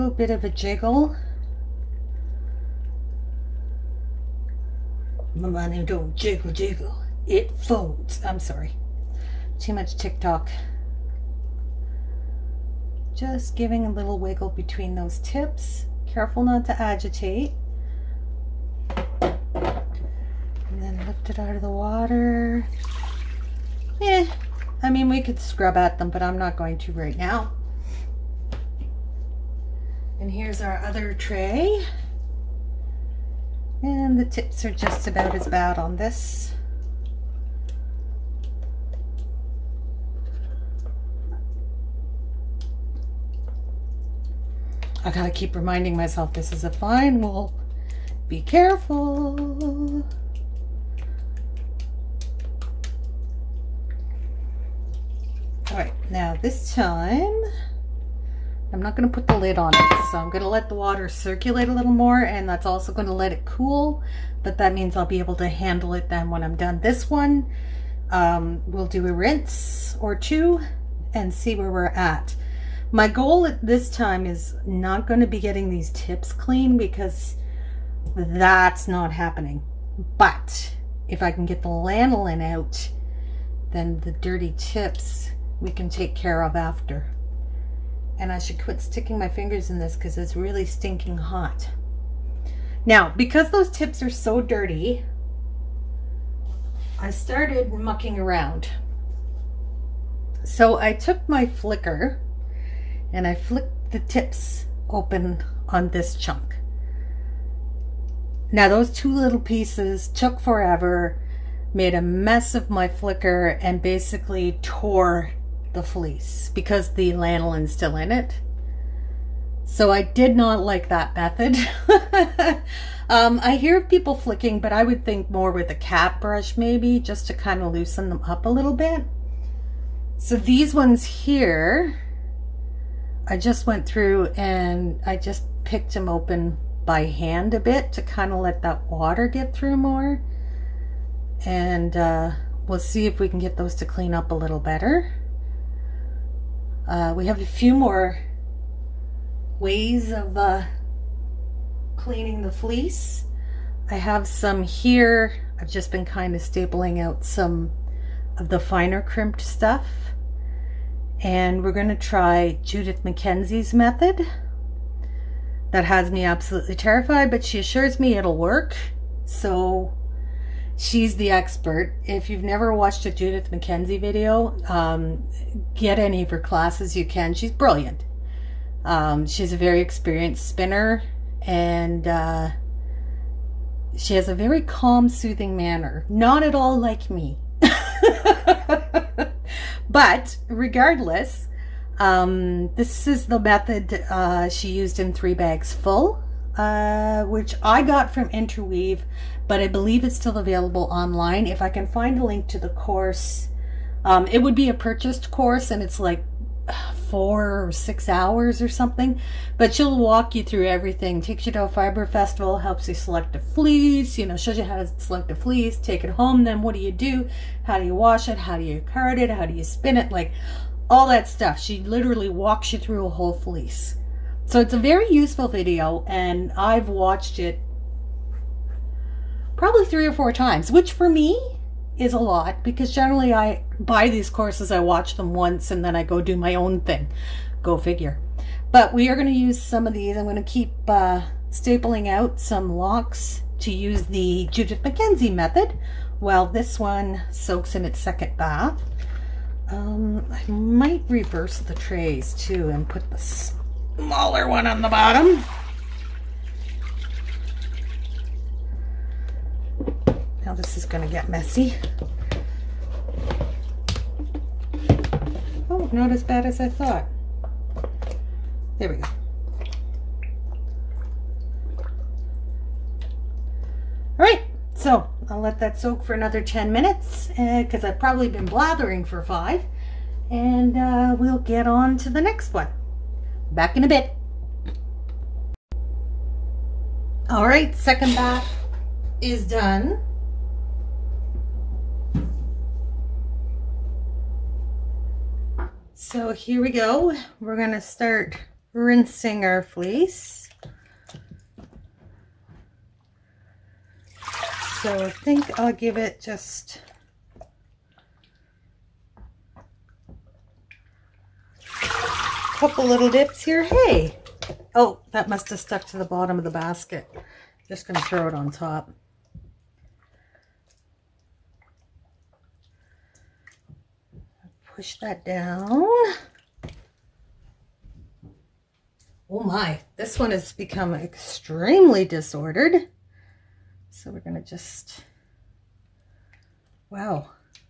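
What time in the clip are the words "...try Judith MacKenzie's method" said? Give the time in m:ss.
2:41.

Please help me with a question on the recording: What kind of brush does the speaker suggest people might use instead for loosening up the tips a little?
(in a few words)
cat brush.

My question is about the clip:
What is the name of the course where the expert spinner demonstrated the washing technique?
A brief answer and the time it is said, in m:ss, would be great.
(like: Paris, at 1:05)
Three Bags Full, at 3:15.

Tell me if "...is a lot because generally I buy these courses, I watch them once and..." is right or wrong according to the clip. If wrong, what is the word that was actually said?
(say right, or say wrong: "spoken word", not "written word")
right.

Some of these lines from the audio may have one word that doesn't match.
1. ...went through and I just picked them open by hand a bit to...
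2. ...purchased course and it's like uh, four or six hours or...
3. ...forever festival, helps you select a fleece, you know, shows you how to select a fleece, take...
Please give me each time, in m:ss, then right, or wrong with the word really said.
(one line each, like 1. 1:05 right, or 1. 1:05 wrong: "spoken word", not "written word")
1. 2:13 right
2. 3:24 right
3. 3:31 wrong: "fiber", not "forever".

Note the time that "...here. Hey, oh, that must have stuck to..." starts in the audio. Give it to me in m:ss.
5:13.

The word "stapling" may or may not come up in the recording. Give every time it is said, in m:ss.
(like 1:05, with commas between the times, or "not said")
2:36, 4:01.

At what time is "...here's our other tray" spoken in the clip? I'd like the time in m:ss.
0:30.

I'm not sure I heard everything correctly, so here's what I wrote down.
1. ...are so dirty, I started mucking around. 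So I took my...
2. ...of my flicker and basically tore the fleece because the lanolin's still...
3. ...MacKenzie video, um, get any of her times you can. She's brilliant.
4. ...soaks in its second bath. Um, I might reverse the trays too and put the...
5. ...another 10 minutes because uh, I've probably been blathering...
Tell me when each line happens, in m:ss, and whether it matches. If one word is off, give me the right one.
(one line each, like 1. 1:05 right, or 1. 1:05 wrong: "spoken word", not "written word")
1. 1:34 right
2. 1:52 right
3. 2:53 wrong: "classes", not "times"
4. 4:07 right
5. 4:36 right.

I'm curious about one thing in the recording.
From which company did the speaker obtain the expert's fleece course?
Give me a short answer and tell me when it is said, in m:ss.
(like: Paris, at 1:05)
Interweave, at 3:18.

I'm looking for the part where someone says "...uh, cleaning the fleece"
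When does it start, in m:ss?
2:30.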